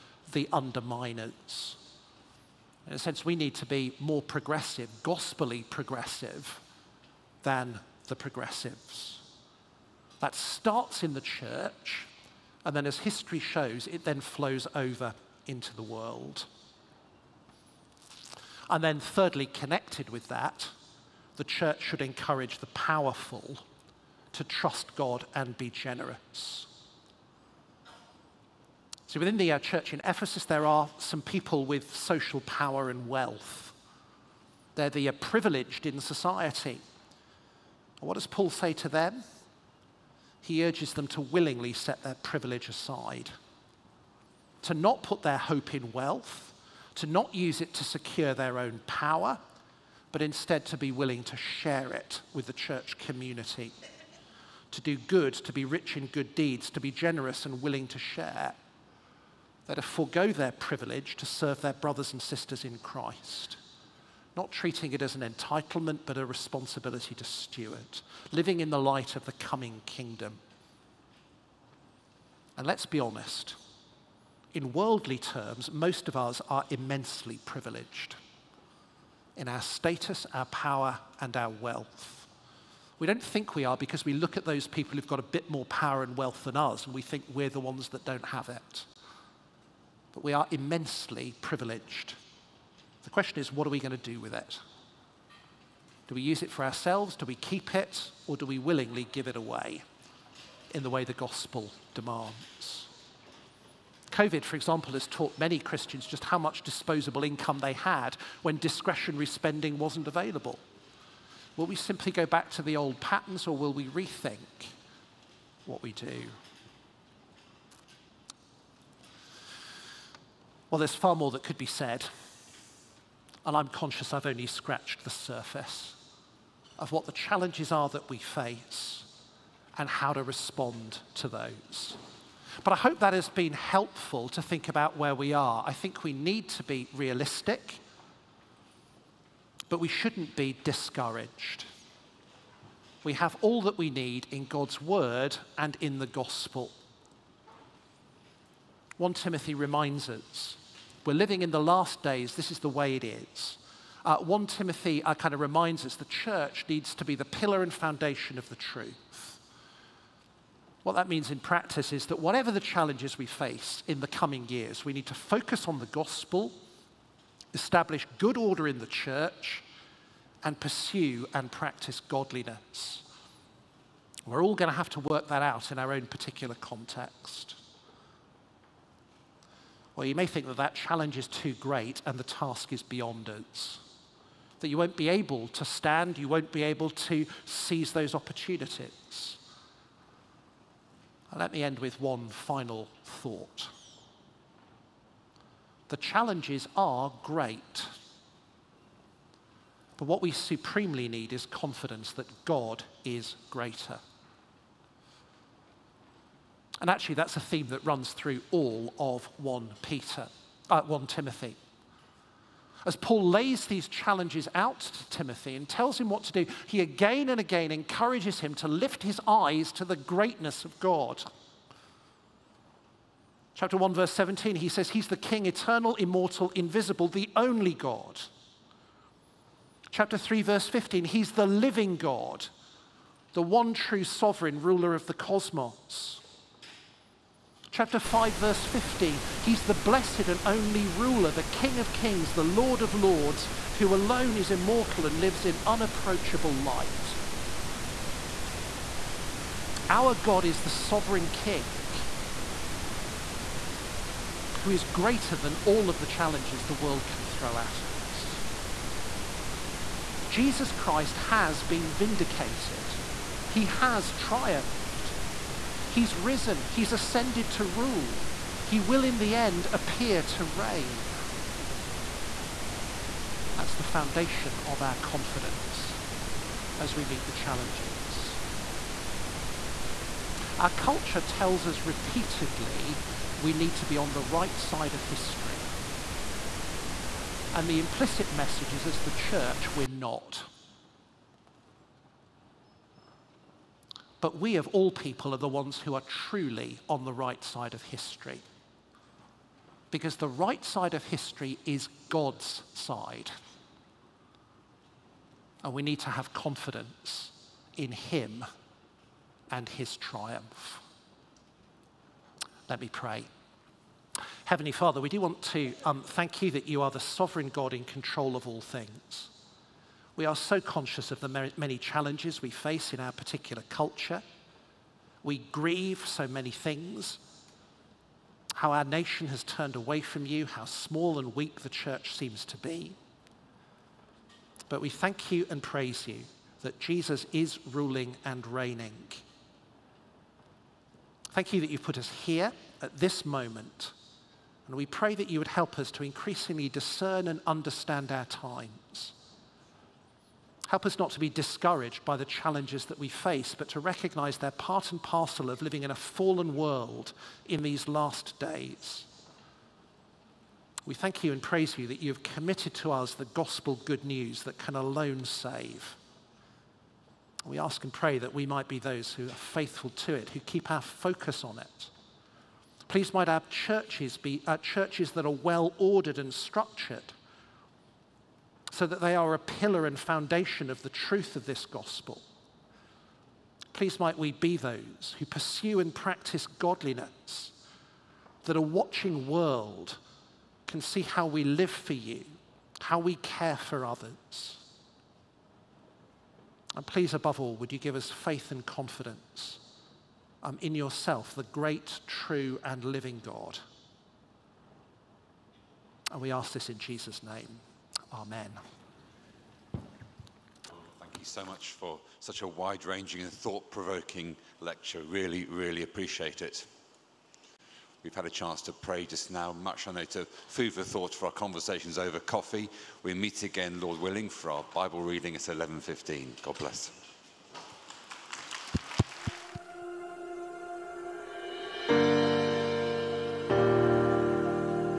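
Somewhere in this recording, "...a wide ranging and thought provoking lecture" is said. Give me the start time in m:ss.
6:52.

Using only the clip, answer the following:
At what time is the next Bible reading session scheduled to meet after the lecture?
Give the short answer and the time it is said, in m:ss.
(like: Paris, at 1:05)
11:15, at 7:05.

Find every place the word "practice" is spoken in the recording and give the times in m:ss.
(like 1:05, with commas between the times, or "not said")
2:41, 2:51, 6:25.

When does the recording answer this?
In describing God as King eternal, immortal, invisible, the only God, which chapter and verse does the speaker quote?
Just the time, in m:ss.
3:43.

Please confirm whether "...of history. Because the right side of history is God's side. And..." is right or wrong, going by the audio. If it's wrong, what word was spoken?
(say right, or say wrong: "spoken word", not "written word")
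right.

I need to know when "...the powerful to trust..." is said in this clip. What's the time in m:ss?
0:22.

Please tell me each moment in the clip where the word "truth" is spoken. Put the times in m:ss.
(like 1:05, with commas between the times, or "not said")
2:38, 6:20.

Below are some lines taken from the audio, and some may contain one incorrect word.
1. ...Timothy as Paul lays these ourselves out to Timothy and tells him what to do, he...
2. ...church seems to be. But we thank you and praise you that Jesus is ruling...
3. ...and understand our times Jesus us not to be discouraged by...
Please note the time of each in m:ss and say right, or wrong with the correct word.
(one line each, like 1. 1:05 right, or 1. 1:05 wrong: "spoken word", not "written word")
1. 3:31 wrong: "challenges", not "ourselves"
2. 5:31 right
3. 5:47 wrong: "Help", not "Jesus".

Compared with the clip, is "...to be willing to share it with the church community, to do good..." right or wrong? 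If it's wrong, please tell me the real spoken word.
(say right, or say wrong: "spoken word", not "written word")
right.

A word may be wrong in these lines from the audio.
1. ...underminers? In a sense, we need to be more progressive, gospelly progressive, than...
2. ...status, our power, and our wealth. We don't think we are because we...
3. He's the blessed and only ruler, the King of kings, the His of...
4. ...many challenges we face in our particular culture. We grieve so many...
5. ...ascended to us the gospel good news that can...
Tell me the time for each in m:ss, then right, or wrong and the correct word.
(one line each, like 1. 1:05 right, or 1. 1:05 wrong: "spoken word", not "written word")
1. 0:00 right
2. 1:19 right
3. 3:59 wrong: "Lord", not "His"
4. 5:21 right
5. 6:02 wrong: "committed", not "ascended".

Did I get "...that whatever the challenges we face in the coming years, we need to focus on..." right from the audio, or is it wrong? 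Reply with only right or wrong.
right.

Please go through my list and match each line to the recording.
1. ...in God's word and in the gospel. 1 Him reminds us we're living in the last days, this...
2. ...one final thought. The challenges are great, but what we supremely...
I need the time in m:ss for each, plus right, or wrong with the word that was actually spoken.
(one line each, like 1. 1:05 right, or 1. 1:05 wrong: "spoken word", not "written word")
1. 2:24 wrong: "Timothy", not "Him"
2. 3:11 right.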